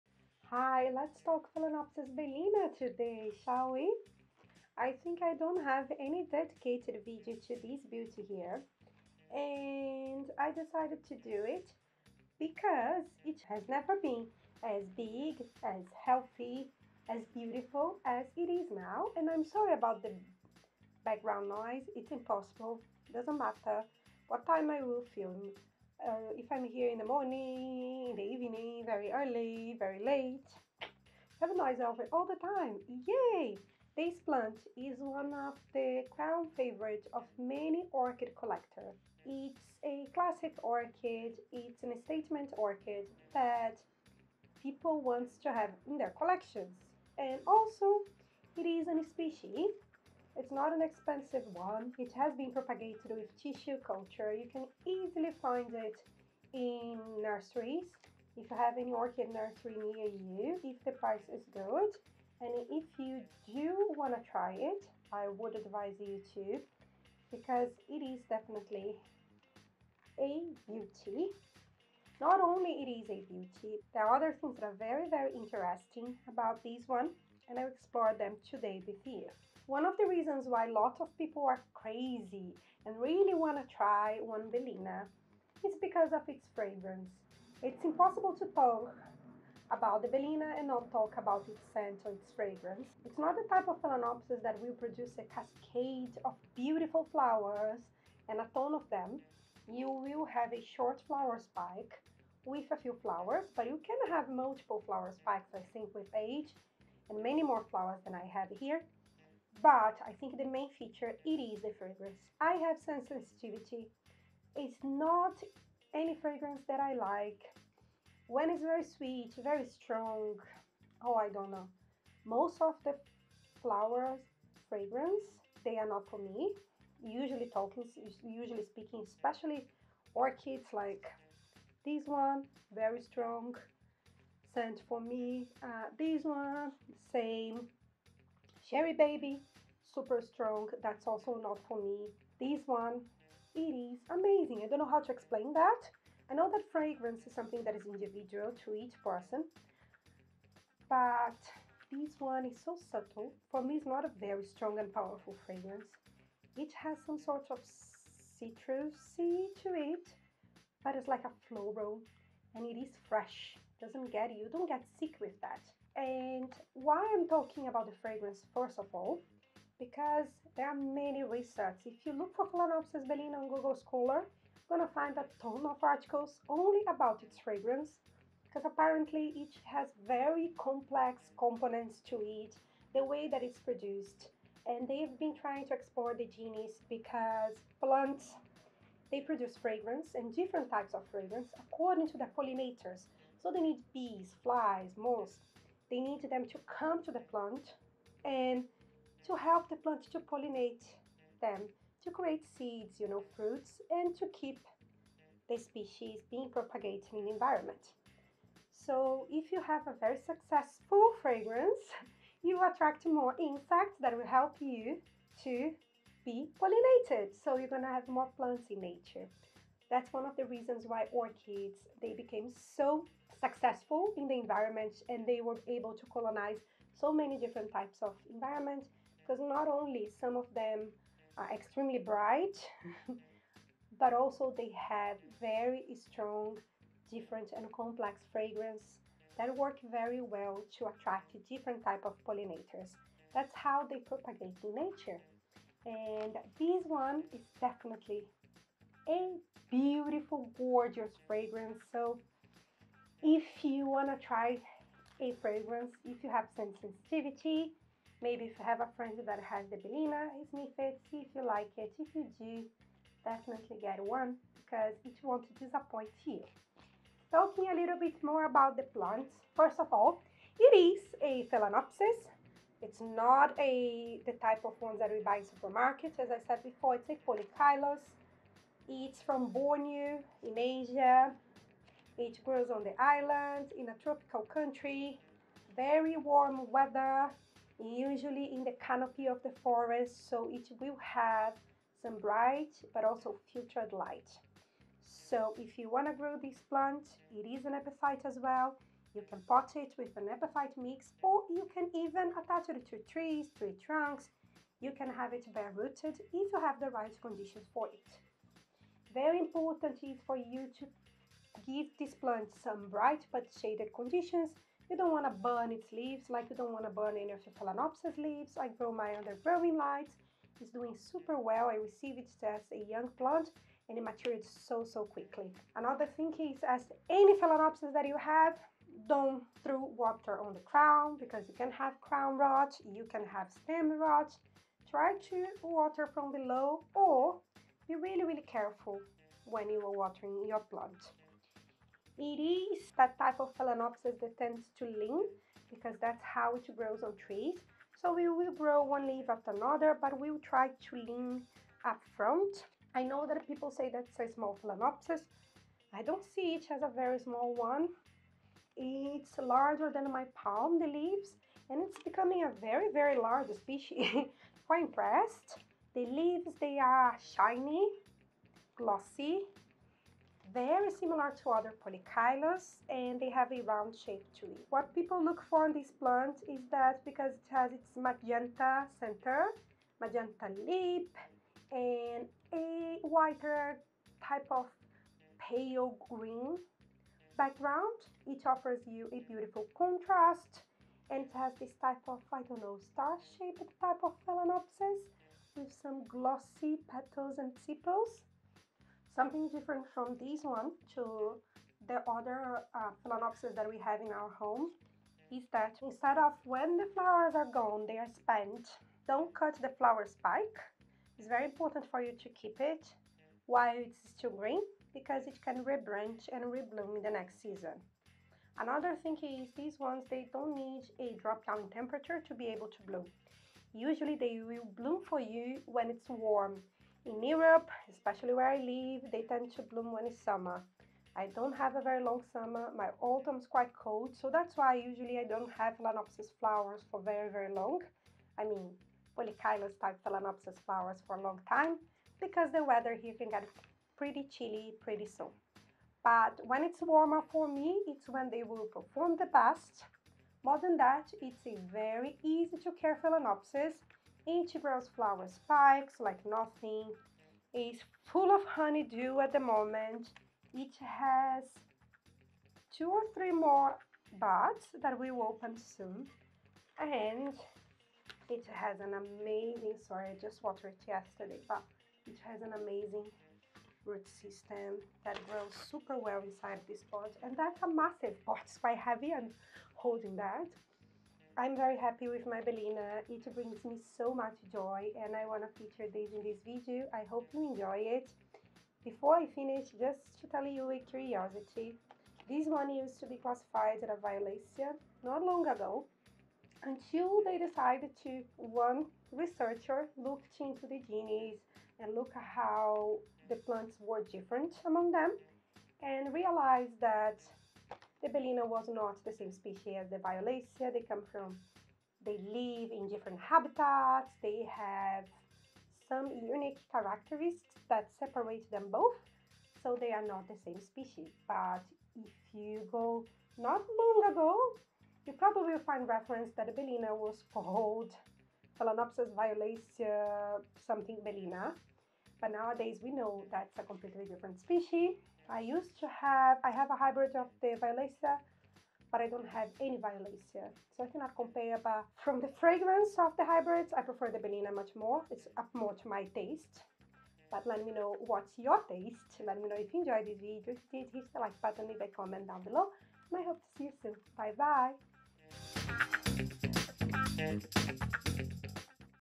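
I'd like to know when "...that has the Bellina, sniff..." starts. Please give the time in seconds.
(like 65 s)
259 s.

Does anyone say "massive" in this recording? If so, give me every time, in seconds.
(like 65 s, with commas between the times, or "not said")
477 s.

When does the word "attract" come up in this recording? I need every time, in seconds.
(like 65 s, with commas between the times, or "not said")
212 s, 240 s.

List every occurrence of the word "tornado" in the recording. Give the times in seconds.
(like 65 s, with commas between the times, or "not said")
not said.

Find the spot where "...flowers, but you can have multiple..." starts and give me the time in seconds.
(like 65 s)
103 s.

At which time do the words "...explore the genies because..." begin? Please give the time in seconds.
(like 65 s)
185 s.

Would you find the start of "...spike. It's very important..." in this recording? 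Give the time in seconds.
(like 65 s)
410 s.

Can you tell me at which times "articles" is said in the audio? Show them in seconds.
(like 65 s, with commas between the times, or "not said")
175 s.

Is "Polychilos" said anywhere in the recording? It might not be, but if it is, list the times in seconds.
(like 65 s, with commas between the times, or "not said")
277 s, 371 s, 439 s.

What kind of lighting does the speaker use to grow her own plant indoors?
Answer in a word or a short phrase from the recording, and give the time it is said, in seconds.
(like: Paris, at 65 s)
Growing lights, at 319 s.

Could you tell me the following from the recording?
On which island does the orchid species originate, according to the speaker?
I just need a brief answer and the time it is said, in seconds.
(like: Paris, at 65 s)
Borneo, at 279 s.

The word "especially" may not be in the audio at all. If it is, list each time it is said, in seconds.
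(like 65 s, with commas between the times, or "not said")
129 s, 427 s.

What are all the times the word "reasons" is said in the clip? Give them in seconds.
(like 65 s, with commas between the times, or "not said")
80 s, 220 s.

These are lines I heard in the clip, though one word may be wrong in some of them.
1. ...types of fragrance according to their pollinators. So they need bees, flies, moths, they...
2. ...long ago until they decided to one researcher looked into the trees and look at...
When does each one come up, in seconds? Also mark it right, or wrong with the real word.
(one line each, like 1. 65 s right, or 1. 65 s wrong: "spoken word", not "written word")
1. 190 s right
2. 495 s wrong: "genies", not "trees".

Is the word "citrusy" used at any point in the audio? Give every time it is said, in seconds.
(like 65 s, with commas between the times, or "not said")
158 s.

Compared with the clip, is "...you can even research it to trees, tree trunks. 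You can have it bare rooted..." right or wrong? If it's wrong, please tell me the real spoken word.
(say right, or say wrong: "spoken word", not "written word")
wrong: "attach", not "research".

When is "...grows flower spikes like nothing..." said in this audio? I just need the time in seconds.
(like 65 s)
454 s.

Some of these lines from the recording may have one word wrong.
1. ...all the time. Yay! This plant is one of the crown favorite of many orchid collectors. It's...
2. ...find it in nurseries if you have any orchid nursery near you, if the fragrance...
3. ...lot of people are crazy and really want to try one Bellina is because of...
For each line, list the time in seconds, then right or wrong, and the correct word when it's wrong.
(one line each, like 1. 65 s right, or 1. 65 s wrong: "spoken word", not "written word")
1. 32 s right
2. 55 s wrong: "price", not "fragrance"
3. 80 s right.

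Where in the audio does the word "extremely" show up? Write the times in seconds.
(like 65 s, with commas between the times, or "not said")
231 s.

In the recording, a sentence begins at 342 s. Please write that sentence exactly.
It is that type of Phalaenopsis that tends to lean because that's how it grows on trees.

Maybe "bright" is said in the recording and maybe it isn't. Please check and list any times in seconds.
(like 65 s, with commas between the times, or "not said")
231 s, 292 s, 312 s.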